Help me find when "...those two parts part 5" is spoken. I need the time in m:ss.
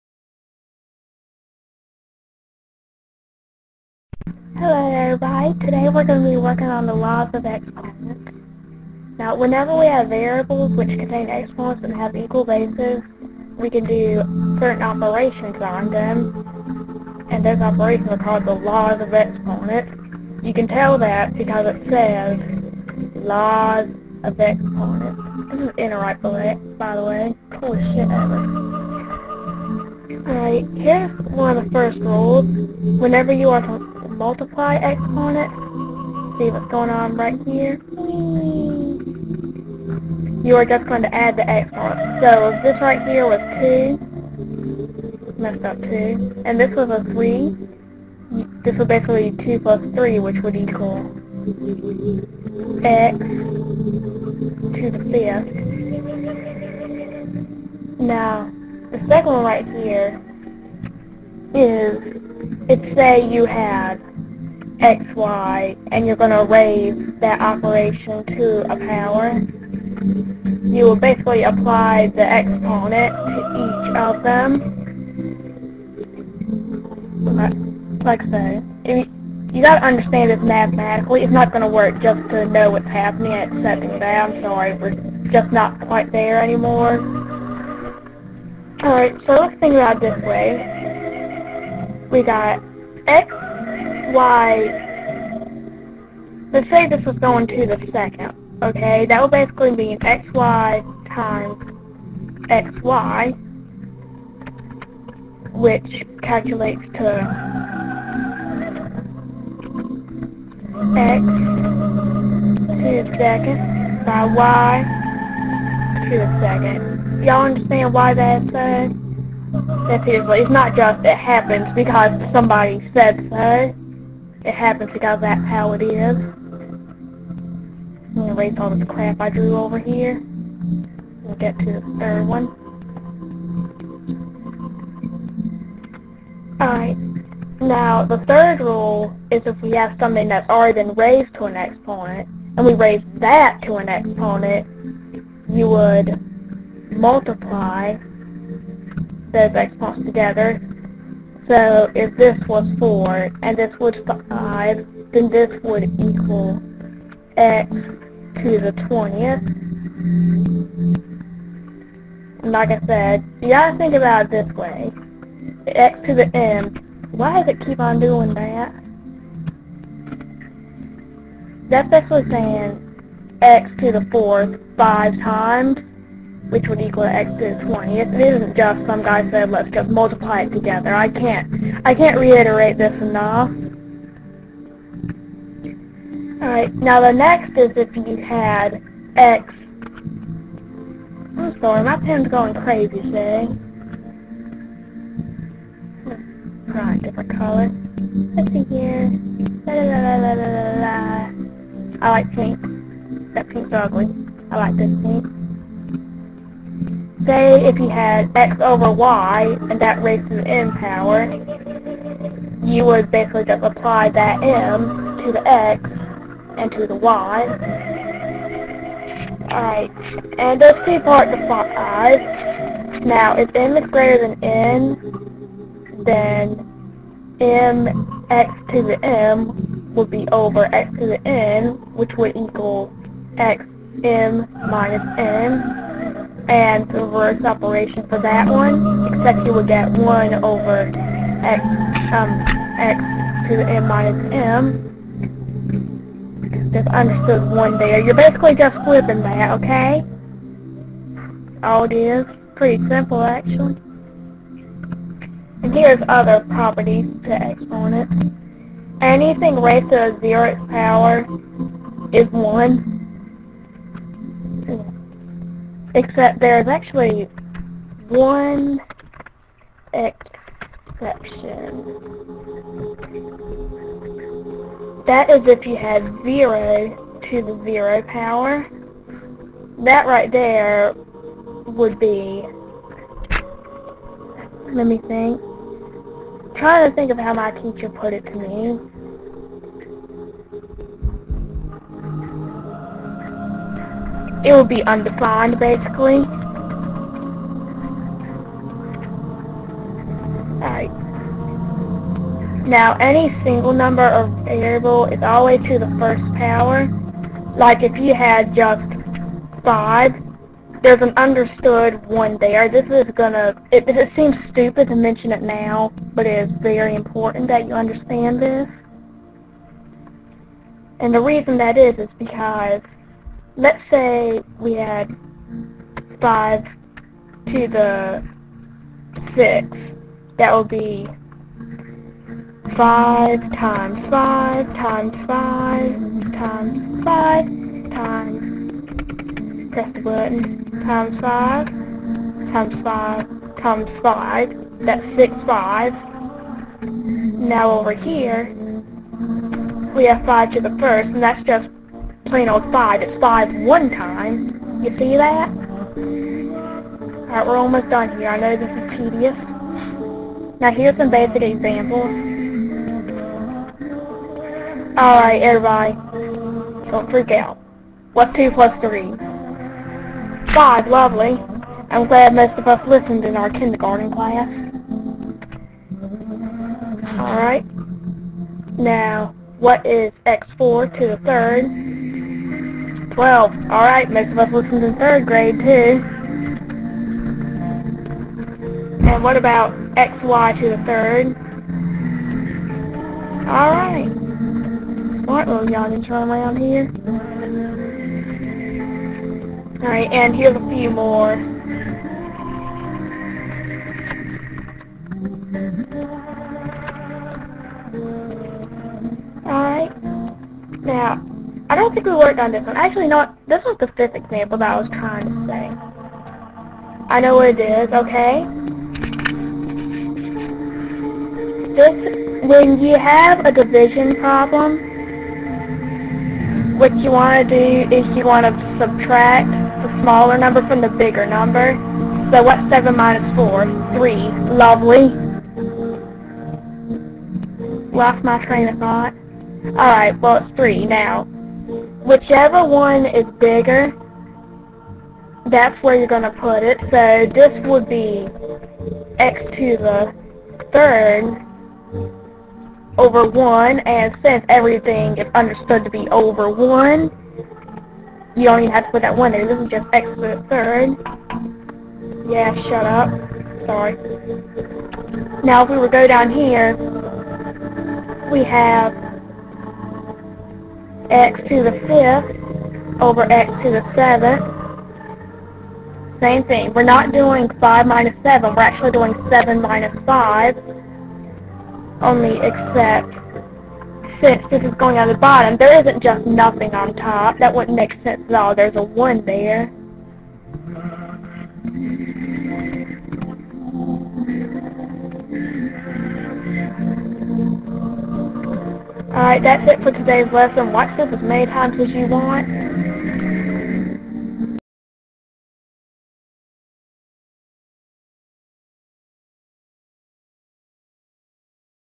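3:40.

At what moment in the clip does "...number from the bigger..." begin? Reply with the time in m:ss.
7:10.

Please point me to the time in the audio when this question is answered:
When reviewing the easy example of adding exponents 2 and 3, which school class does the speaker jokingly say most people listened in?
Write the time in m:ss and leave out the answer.
6:13.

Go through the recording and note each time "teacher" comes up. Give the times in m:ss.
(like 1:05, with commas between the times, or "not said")
4:47.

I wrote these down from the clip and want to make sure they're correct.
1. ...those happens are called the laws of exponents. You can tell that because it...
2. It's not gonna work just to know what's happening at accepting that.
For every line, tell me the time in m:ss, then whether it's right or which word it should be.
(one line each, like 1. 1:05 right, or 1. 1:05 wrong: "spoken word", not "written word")
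1. 0:17 wrong: "operations", not "happens"
2. 1:21 right.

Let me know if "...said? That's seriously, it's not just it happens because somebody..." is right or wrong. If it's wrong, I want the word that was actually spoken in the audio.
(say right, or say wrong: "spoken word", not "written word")
right.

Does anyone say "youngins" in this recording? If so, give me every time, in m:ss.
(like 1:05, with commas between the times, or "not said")
6:35.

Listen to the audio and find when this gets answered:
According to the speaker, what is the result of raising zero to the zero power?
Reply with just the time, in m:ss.
4:54.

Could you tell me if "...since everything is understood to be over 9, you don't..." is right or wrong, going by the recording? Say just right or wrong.
wrong.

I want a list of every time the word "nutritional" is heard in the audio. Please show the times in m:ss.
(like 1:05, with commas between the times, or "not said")
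not said.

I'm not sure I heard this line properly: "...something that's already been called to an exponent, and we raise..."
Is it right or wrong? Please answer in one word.
wrong.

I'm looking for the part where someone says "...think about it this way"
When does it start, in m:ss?
2:43.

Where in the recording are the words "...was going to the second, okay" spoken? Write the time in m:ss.
1:37.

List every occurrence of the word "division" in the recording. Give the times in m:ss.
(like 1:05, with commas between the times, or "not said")
7:03.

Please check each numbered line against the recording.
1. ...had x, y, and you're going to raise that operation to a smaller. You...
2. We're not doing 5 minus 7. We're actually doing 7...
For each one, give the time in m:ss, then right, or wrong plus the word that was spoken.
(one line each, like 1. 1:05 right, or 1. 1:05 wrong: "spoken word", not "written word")
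1. 1:03 wrong: "power", not "smaller"
2. 7:56 right.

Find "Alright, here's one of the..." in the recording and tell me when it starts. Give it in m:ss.
0:30.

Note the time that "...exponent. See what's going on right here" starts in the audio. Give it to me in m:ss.
0:34.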